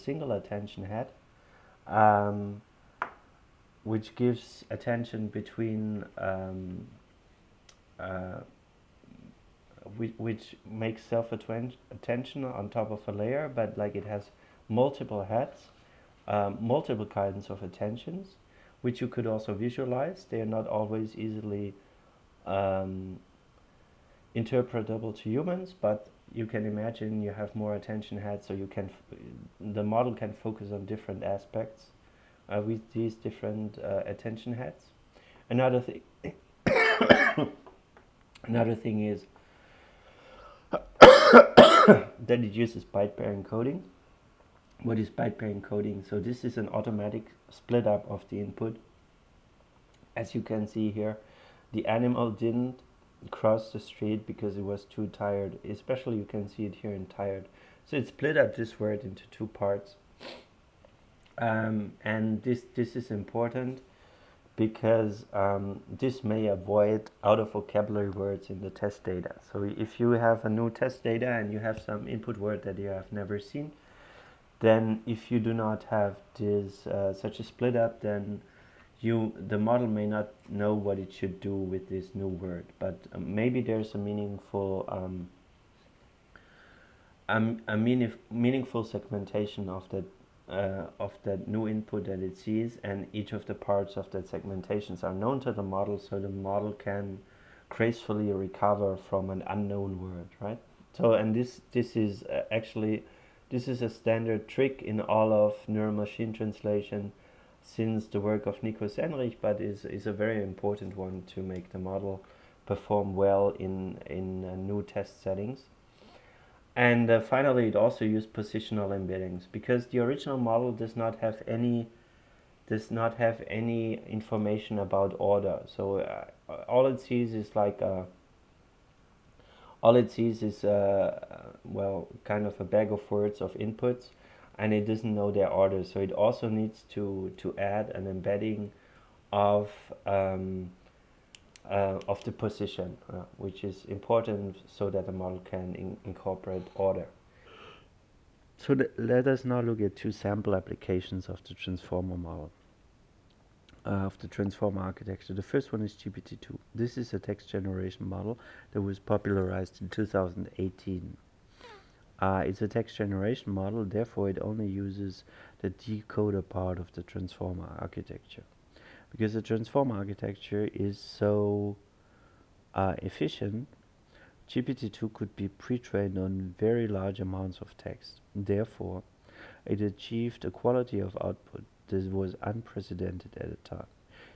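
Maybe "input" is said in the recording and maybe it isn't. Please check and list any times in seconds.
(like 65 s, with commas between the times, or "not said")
48 s, 72 s, 91 s, 133 s.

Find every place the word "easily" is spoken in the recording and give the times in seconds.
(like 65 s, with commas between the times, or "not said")
21 s.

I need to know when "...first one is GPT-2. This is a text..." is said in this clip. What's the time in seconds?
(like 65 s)
155 s.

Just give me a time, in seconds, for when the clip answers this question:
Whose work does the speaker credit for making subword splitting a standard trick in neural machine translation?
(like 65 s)
108 s.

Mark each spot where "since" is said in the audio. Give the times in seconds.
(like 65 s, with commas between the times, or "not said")
107 s.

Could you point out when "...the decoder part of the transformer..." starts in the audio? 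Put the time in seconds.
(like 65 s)
165 s.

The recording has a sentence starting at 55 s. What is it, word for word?
Especially you can see it here in tired.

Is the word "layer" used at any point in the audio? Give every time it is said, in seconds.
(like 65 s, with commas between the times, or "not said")
13 s.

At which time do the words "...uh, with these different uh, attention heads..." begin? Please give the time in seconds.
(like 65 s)
32 s.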